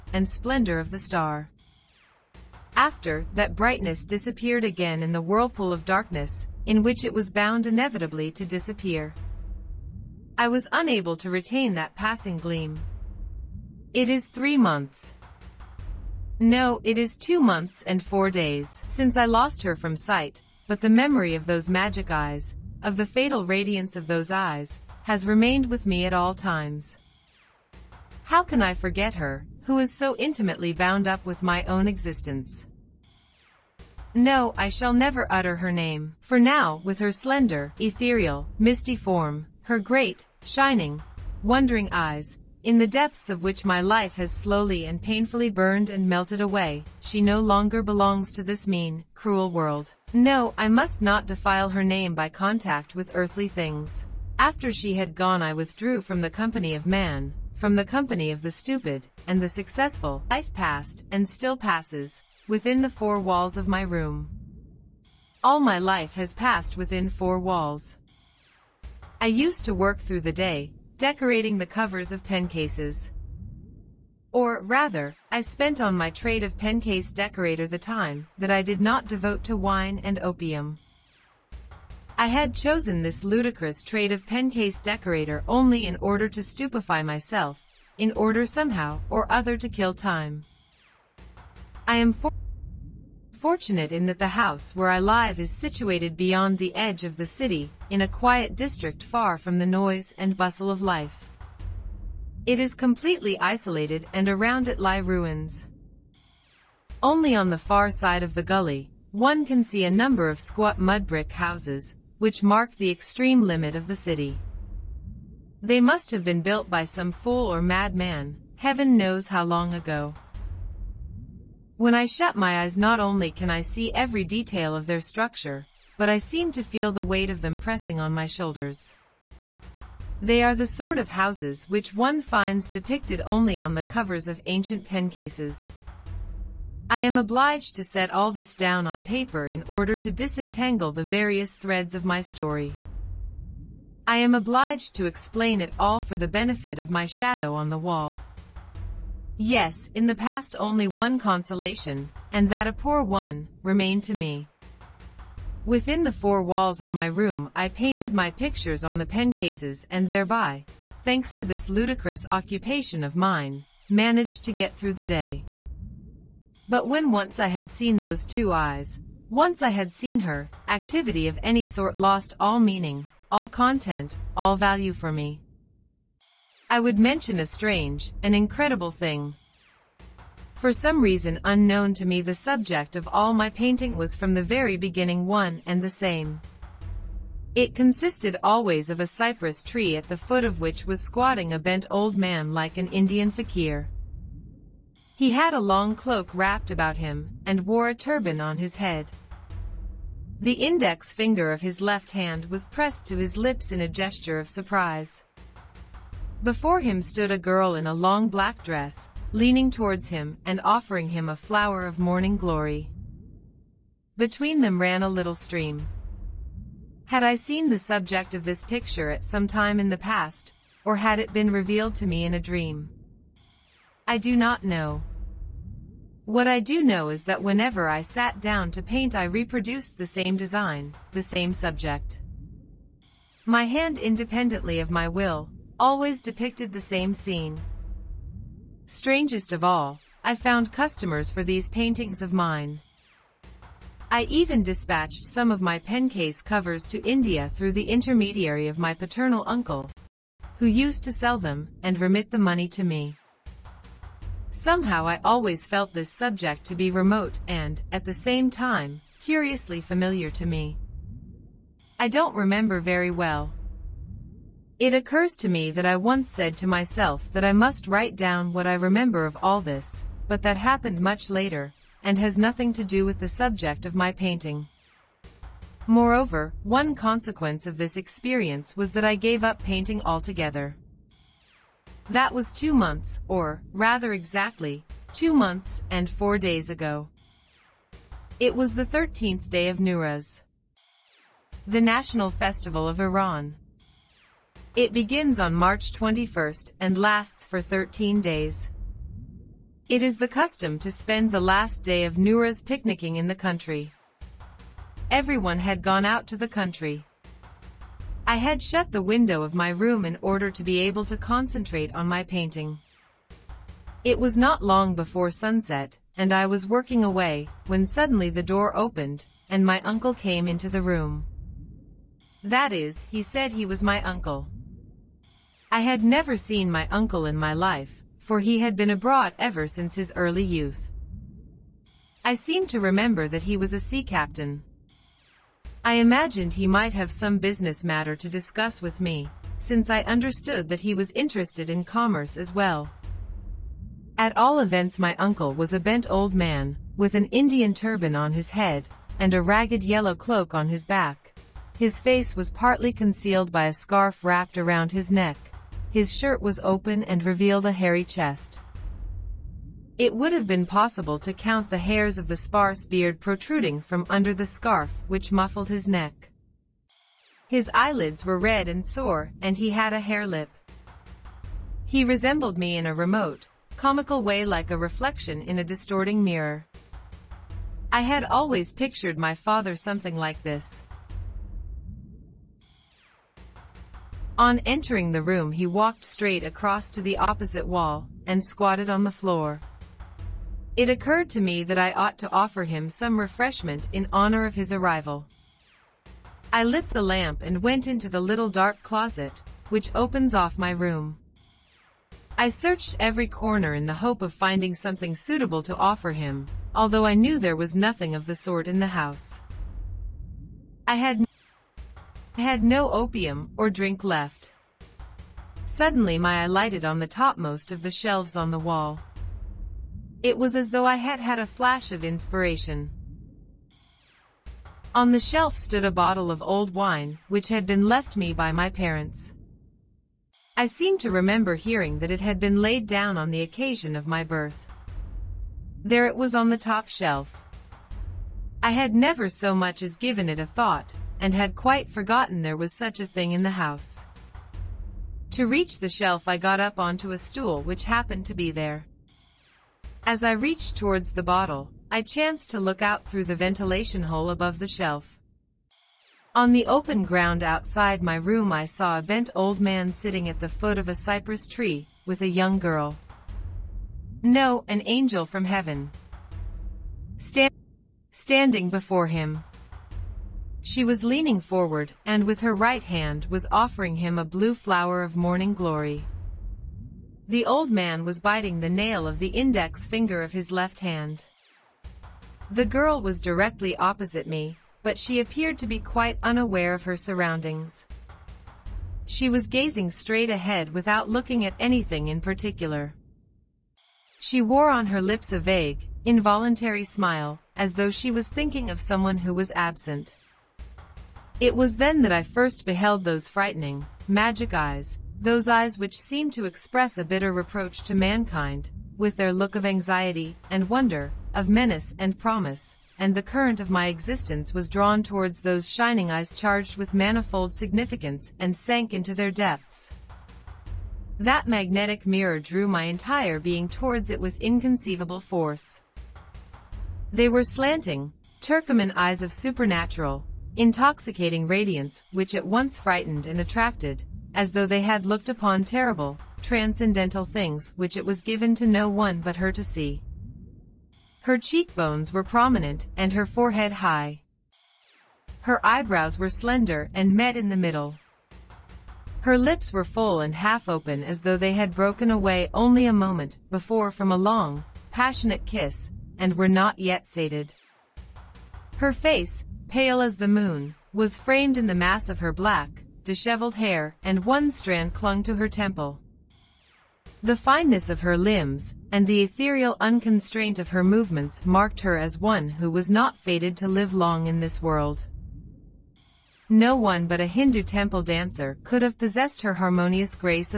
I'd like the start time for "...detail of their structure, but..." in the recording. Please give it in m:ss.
2:04.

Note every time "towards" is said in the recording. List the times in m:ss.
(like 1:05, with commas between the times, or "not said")
3:29, 7:30, 8:35, 8:43.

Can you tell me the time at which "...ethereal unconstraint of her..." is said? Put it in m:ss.
9:29.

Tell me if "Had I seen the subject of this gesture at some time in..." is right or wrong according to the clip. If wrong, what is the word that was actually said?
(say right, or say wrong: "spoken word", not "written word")
wrong: "picture", not "gesture".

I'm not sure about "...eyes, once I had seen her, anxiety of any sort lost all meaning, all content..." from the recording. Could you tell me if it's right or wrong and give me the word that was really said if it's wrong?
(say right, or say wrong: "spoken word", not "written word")
wrong: "activity", not "anxiety".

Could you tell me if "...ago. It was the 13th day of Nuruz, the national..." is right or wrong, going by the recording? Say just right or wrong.
right.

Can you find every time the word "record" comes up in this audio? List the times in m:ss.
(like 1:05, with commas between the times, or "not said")
not said.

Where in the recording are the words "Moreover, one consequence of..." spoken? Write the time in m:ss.
4:35.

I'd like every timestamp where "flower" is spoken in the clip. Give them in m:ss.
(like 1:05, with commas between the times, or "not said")
3:31, 7:54.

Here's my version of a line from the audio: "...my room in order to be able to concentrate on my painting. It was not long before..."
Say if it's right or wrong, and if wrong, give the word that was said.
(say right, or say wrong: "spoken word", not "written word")
right.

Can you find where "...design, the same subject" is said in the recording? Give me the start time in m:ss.
3:50.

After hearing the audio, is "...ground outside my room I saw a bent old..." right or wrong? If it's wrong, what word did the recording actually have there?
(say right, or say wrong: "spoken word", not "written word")
right.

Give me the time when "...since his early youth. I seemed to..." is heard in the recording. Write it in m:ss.
5:29.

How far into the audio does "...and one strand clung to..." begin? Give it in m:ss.
9:24.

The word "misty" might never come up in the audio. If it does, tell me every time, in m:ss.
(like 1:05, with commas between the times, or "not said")
0:38.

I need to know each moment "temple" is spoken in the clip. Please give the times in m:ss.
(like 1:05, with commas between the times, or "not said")
9:25, 9:37.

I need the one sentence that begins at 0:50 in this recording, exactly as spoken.
No, I must not defile her name by contact with earthly things.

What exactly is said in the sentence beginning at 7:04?
On the shelf stood a bottle of old wine, which had been left me by my parents.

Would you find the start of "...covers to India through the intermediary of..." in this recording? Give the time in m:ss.
4:06.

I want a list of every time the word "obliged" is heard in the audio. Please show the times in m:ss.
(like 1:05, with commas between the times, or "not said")
2:17, 2:24.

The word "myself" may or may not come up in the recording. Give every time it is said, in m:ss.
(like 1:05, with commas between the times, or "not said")
1:27, 4:26.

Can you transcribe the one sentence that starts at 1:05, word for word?
All my life has passed within four walls.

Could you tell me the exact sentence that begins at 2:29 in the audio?
Yes, in the past only one consolation, and that a poor one, remained to me.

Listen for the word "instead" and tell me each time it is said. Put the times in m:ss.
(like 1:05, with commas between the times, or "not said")
not said.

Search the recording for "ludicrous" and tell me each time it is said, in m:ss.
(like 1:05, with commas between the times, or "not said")
1:23, 2:41.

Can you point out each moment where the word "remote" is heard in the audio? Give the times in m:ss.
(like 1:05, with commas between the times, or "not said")
4:16, 6:12.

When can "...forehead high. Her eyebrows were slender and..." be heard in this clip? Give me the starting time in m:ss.
9:03.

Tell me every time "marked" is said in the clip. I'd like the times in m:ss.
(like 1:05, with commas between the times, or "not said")
1:52, 9:31.